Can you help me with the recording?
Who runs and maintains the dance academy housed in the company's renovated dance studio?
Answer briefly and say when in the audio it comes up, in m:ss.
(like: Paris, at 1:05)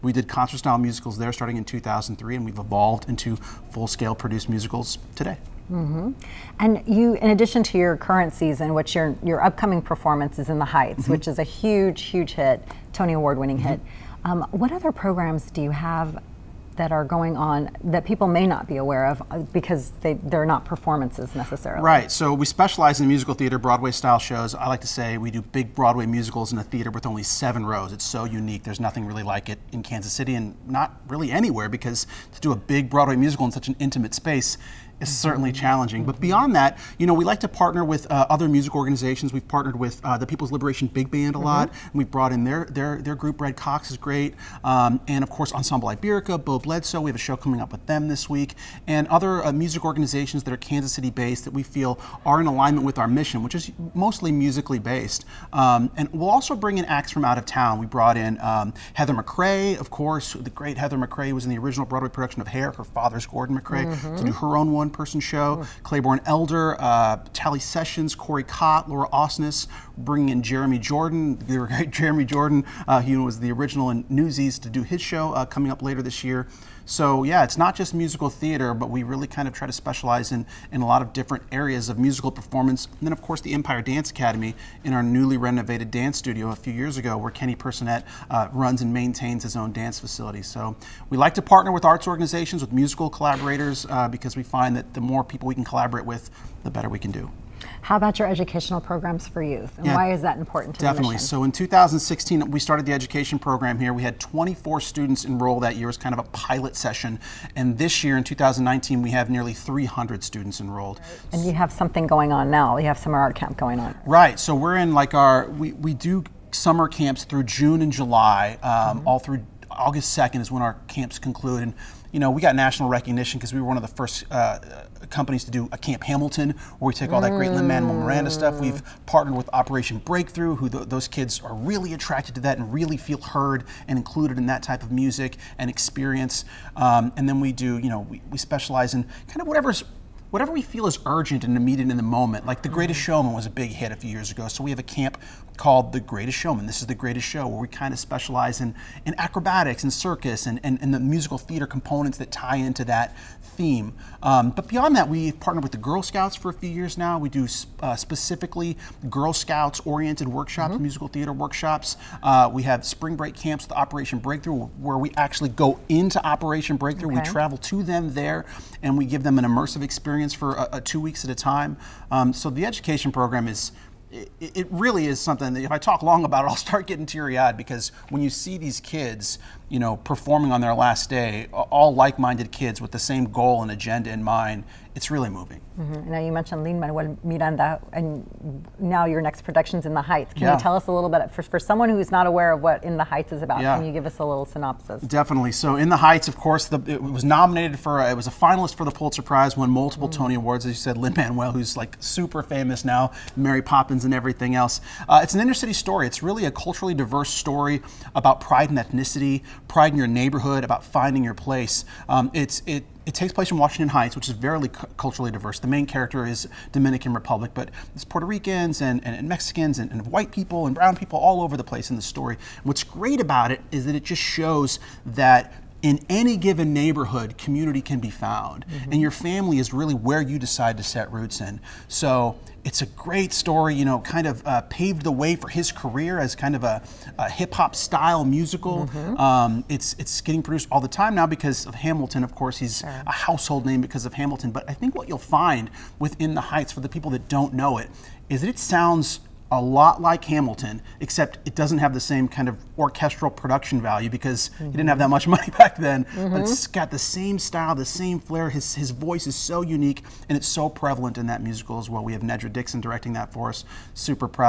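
Kenny Personette, at 1:27.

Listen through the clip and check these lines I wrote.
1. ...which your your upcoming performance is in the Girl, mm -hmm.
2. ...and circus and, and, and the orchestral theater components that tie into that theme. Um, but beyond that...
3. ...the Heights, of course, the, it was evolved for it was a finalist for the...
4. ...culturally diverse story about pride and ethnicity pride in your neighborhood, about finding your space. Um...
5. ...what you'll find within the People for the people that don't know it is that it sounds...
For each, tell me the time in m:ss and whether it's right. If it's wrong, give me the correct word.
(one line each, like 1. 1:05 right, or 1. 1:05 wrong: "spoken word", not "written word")
1. 0:08 wrong: "Heights", not "Girl"
2. 2:29 wrong: "musical", not "orchestral"
3. 3:15 wrong: "nominated", not "evolved"
4. 3:26 wrong: "place", not "space"
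5. 4:04 wrong: "Heights", not "People".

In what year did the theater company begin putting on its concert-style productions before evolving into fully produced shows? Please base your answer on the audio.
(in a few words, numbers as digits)
2003.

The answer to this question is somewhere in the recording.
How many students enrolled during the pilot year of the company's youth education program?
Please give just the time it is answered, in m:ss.
1:44.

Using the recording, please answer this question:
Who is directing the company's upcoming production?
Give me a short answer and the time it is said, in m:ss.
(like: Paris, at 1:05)
Nedra Dixon, at 4:22.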